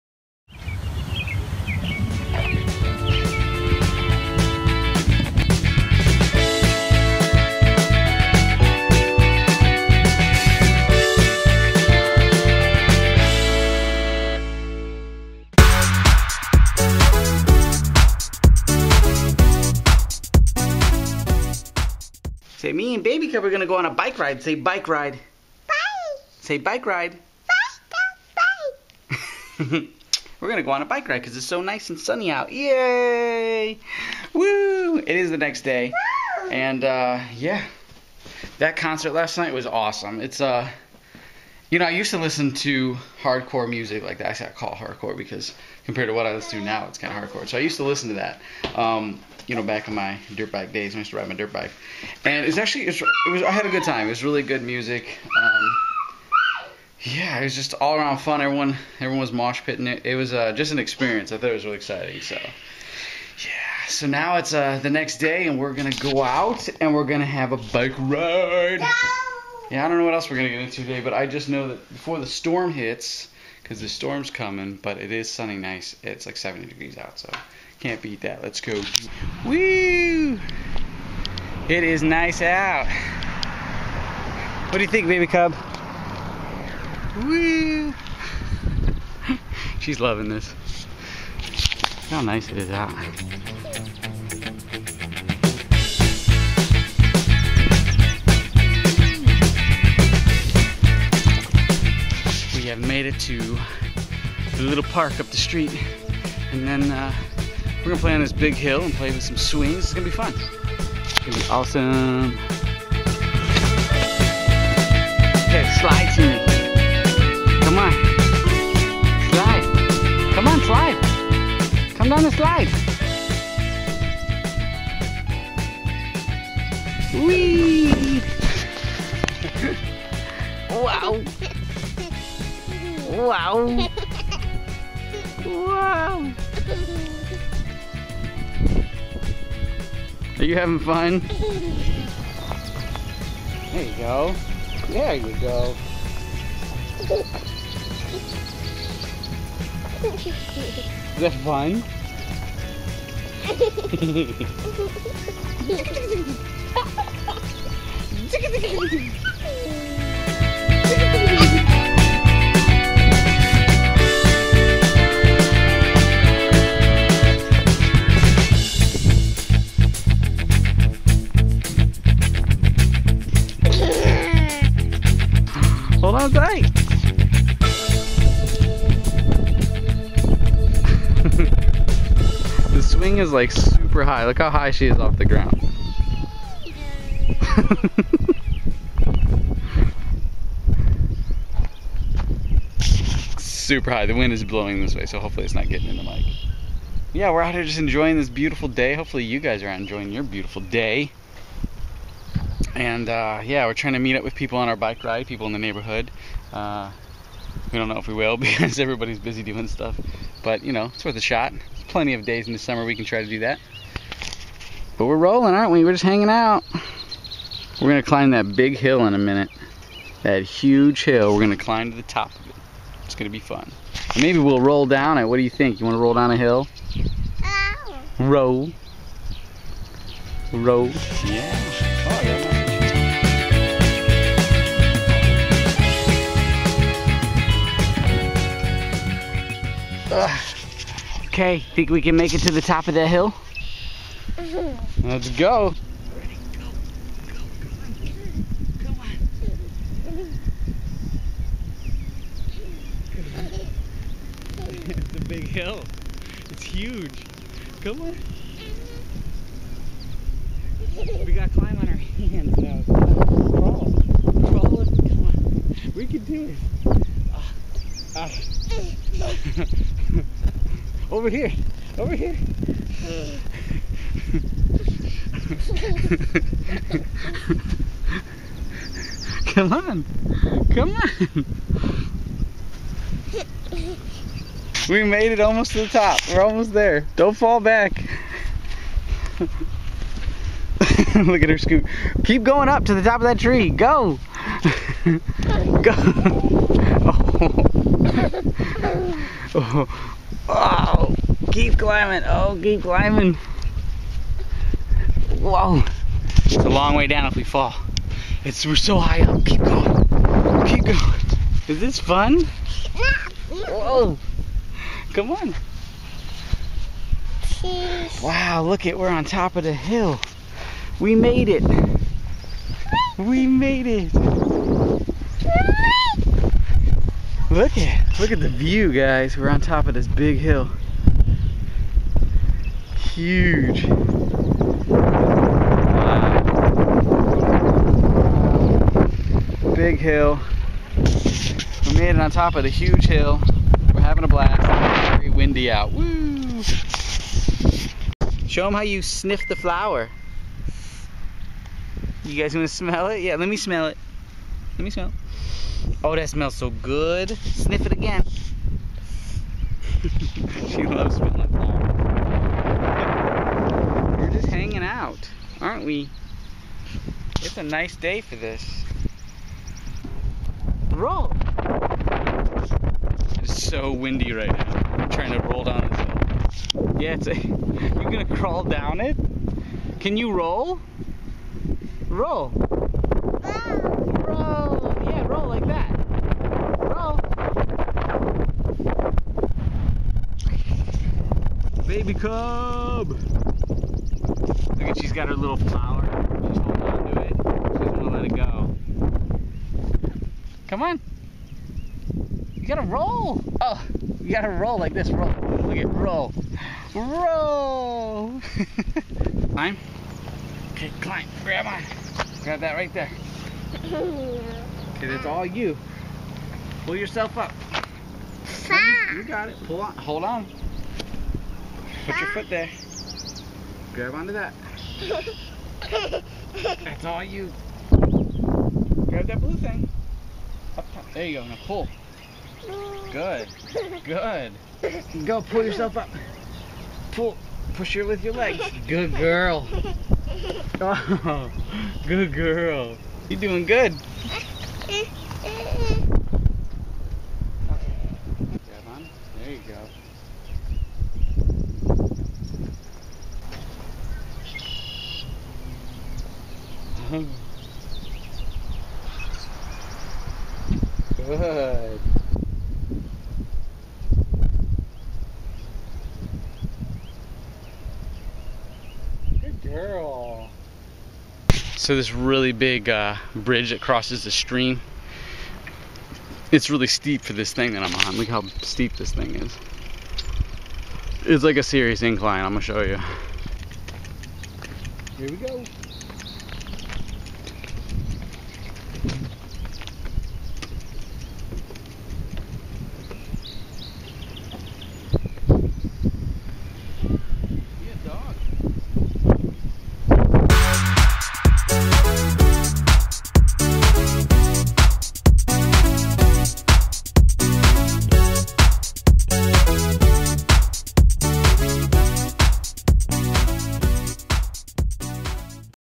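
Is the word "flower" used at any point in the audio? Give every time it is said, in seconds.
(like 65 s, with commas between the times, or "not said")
349 s, 361 s, 395 s.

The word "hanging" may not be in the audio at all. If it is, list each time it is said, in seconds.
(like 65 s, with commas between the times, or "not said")
216 s, 364 s.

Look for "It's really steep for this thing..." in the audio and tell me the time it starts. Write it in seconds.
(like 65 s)
476 s.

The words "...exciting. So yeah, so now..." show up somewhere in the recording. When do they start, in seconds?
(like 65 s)
61 s.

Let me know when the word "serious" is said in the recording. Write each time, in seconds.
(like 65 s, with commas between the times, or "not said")
481 s.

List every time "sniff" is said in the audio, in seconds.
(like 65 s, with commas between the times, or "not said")
349 s, 357 s.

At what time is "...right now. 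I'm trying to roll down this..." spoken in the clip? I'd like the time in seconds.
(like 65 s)
374 s.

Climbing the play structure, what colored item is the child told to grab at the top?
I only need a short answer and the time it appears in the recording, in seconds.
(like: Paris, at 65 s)
blue thing, at 429 s.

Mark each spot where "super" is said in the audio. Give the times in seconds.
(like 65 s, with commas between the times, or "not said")
183 s, 193 s.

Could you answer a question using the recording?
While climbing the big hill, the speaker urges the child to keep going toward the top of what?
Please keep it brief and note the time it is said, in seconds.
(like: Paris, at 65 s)
that tree, at 293 s.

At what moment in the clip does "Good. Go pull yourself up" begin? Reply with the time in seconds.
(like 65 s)
434 s.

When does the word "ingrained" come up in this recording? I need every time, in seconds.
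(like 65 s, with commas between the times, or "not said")
not said.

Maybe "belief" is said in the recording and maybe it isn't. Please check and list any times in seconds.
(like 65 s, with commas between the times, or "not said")
not said.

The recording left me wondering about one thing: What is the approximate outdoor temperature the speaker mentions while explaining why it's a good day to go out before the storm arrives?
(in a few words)
70 degrees.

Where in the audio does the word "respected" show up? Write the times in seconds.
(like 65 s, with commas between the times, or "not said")
not said.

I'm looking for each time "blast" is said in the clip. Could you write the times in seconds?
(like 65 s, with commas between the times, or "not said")
344 s.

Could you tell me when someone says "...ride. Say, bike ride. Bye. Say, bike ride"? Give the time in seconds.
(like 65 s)
24 s.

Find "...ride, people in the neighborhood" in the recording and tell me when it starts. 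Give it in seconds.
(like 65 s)
205 s.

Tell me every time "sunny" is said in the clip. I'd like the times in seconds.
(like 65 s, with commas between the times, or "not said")
31 s, 75 s.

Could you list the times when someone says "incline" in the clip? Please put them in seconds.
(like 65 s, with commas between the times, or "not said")
482 s.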